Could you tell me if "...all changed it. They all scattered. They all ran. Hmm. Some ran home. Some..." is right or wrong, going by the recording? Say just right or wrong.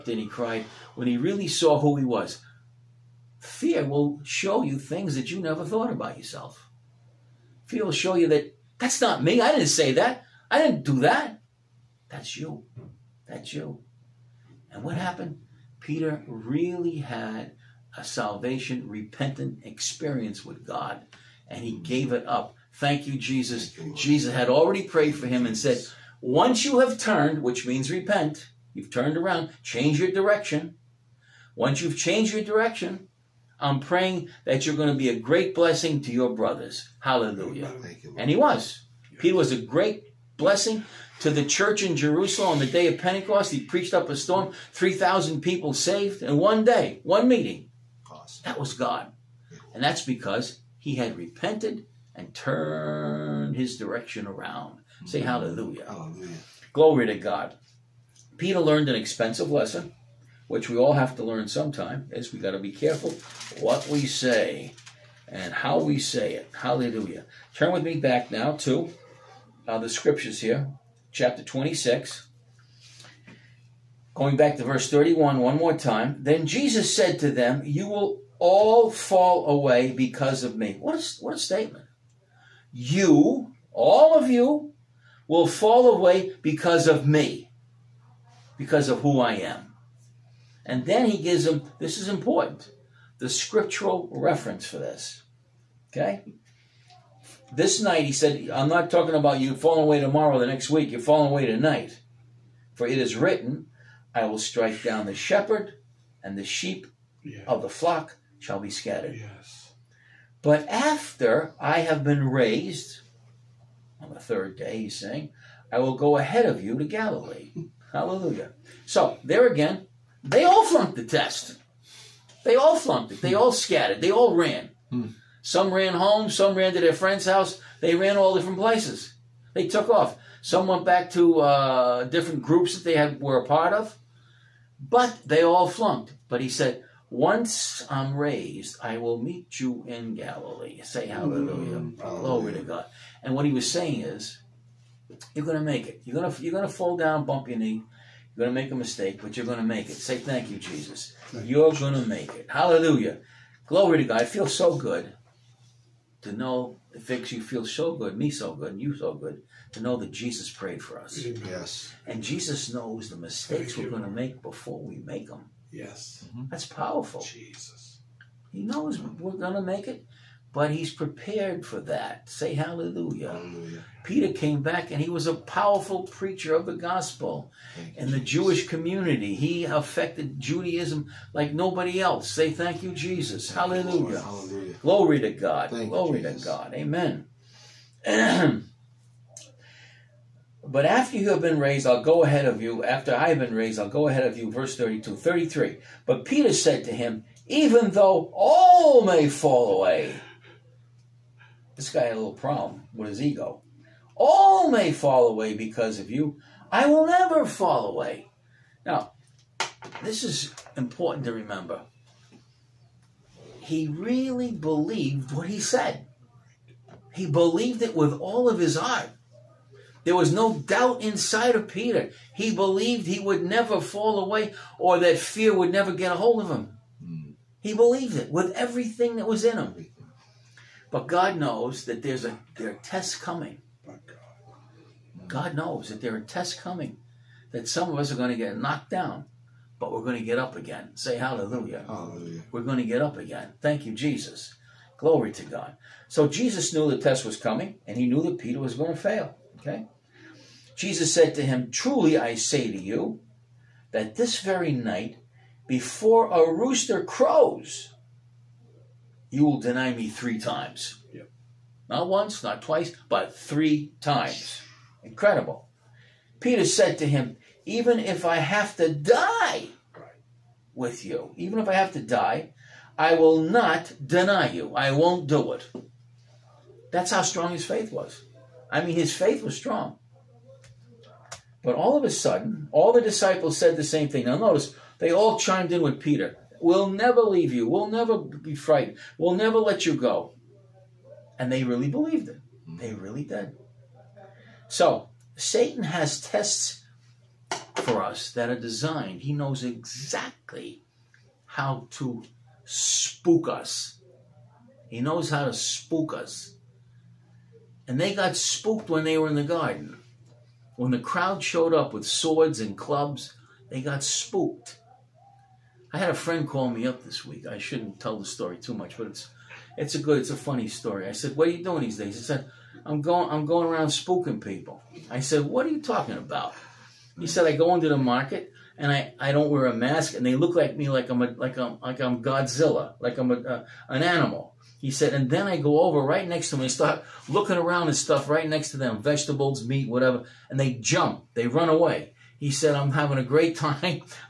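wrong.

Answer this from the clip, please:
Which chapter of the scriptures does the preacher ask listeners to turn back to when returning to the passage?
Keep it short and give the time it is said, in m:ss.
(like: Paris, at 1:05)
26, at 1:11.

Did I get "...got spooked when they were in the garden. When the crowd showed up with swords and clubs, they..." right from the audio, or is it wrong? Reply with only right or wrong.
right.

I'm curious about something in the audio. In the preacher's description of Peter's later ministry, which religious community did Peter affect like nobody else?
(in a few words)
Judaism.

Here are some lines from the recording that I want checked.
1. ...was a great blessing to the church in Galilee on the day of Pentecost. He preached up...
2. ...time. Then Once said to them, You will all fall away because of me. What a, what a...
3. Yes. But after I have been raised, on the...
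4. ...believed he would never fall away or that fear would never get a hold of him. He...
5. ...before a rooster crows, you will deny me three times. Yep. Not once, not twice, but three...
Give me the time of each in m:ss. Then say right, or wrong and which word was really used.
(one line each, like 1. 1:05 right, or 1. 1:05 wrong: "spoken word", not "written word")
1. 0:39 wrong: "Jerusalem", not "Galilee"
2. 1:15 wrong: "Jesus", not "Once"
3. 1:49 right
4. 3:42 right
5. 4:15 right.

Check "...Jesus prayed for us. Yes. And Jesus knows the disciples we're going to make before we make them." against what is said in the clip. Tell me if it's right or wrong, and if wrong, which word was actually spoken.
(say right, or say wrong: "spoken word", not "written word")
wrong: "mistakes", not "disciples".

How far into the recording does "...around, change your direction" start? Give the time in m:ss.
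0:29.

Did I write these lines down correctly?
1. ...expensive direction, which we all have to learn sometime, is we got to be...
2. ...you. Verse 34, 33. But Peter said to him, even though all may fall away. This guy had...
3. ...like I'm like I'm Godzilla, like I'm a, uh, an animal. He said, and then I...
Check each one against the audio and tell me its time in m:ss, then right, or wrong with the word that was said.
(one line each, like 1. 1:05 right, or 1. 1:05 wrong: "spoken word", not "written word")
1. 0:58 wrong: "lesson", not "direction"
2. 3:14 wrong: "32", not "34"
3. 5:31 right.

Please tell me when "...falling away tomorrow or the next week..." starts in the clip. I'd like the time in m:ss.
1:39.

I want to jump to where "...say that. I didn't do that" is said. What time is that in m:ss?
0:09.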